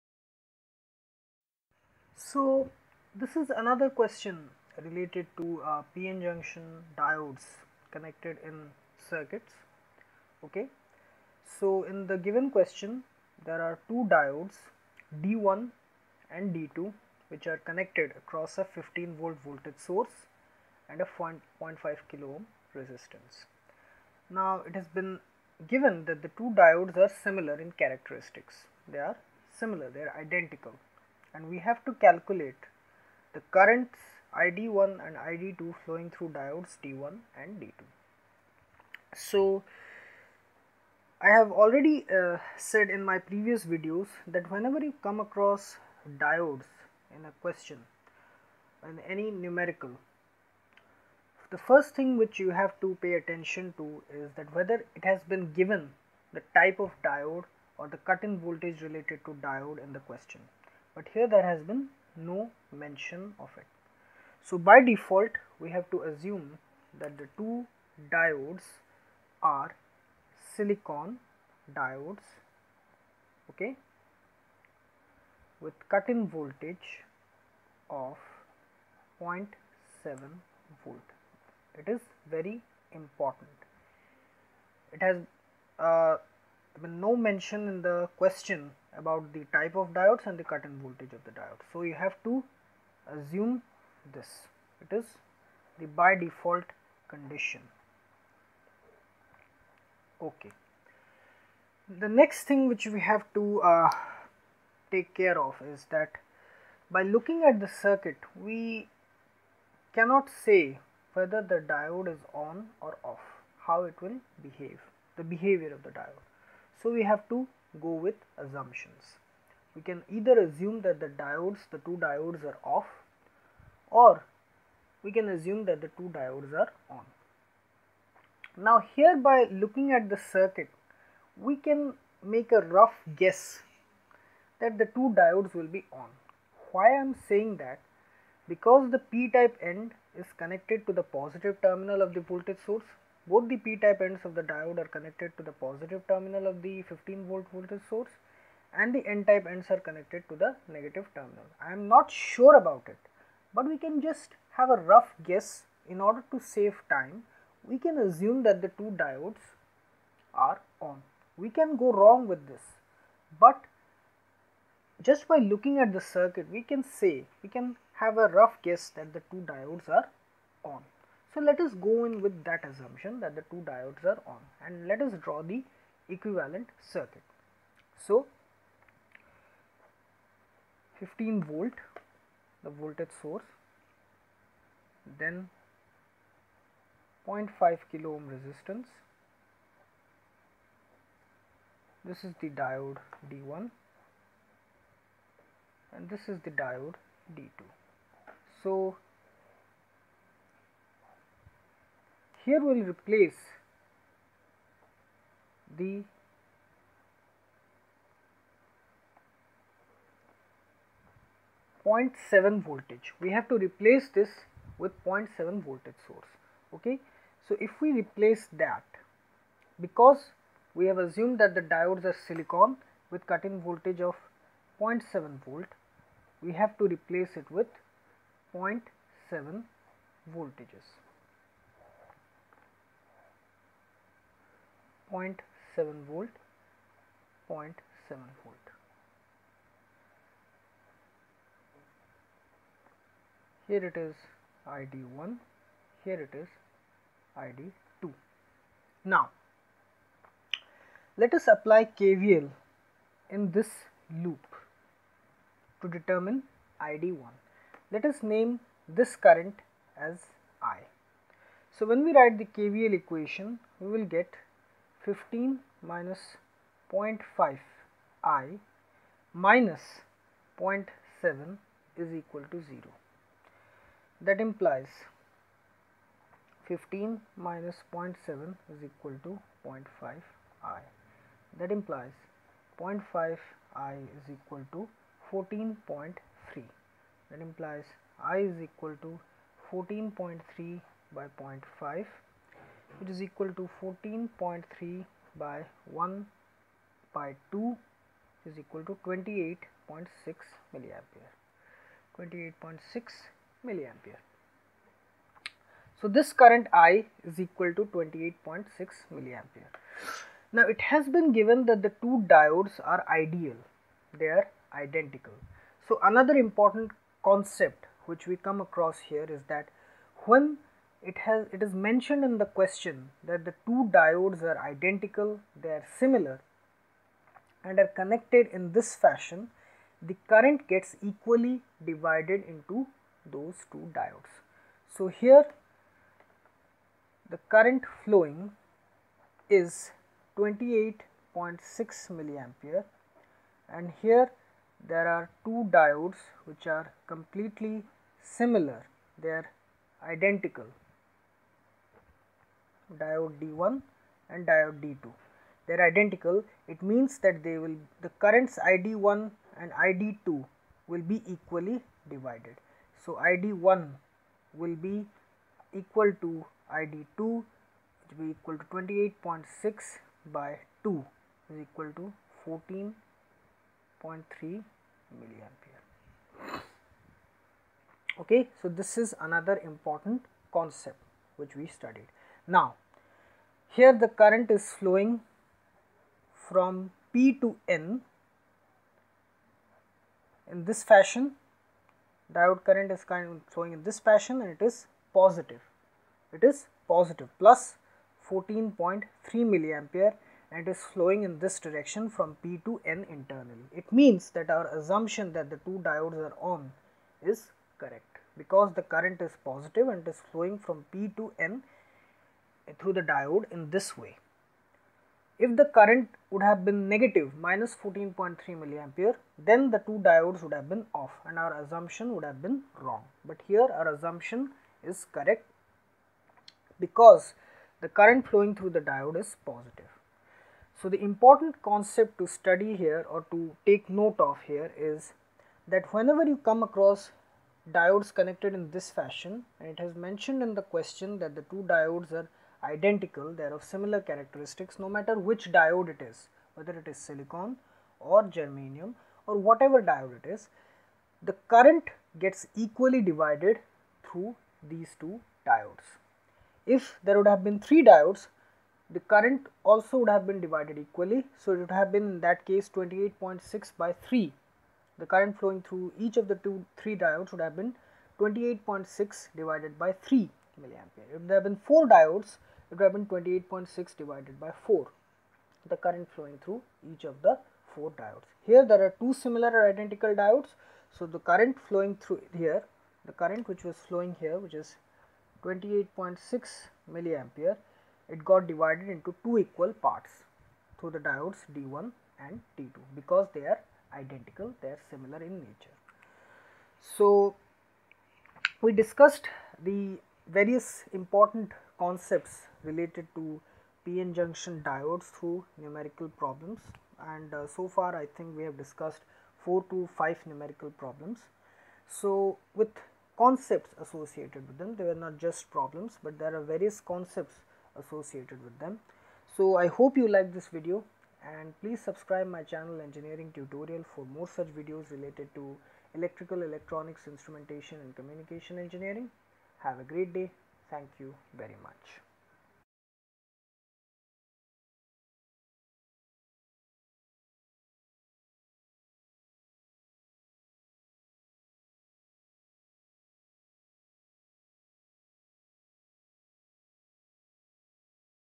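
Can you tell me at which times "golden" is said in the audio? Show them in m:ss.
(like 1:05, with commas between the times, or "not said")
not said.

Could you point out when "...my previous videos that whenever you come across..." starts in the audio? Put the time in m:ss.
0:43.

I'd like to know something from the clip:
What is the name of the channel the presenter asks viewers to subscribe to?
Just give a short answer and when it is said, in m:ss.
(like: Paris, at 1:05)
engineering tutorial, at 8:42.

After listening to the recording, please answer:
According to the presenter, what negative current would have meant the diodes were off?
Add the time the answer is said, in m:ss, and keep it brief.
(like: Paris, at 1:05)
-14.3 milliampere, at 6:57.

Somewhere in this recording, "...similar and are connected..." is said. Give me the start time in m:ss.
5:25.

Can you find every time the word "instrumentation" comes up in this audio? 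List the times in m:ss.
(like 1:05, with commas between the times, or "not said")
8:47.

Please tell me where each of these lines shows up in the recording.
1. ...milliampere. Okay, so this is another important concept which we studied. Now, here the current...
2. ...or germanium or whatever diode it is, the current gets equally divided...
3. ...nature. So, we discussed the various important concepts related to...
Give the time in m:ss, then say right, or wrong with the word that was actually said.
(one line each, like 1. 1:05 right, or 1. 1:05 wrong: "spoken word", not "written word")
1. 6:15 right
2. 7:27 right
3. 8:15 right.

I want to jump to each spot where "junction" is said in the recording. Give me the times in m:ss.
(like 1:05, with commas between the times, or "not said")
0:06, 8:24.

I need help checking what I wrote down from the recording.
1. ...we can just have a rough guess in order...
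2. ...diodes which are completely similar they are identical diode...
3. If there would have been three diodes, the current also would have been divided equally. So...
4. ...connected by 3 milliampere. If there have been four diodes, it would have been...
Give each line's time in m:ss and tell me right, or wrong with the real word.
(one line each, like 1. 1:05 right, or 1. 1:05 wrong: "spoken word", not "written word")
1. 2:33 right
2. 5:45 right
3. 7:36 right
4. 7:49 wrong: "divided", not "connected".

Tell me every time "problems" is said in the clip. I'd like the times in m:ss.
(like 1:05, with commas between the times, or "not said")
8:26, 8:30, 8:35.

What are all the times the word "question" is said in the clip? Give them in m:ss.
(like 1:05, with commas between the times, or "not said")
0:03, 0:12, 0:47, 0:59, 1:28, 5:22, 7:20.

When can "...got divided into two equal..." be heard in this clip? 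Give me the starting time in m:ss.
8:08.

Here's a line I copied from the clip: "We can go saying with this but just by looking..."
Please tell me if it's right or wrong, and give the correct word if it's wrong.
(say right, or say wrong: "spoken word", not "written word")
wrong: "wrong", not "saying".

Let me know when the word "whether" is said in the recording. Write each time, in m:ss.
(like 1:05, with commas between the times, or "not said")
0:54, 1:51, 7:26.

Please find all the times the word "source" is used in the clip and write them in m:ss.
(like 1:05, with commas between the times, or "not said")
0:19, 2:22, 2:27, 3:03, 3:36.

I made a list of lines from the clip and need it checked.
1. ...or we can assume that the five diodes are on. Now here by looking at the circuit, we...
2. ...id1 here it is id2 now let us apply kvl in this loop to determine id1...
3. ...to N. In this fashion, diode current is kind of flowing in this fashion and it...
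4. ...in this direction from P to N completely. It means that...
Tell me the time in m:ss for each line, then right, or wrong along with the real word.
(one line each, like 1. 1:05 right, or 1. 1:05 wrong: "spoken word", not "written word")
1. 2:03 wrong: "two", not "five"
2. 4:04 right
3. 6:27 right
4. 6:41 wrong: "internally", not "completely".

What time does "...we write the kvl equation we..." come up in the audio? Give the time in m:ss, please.
4:22.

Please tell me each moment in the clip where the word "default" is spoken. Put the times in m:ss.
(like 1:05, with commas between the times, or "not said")
1:04, 1:36.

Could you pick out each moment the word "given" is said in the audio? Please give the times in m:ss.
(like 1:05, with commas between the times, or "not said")
0:12, 0:25, 0:55, 5:11.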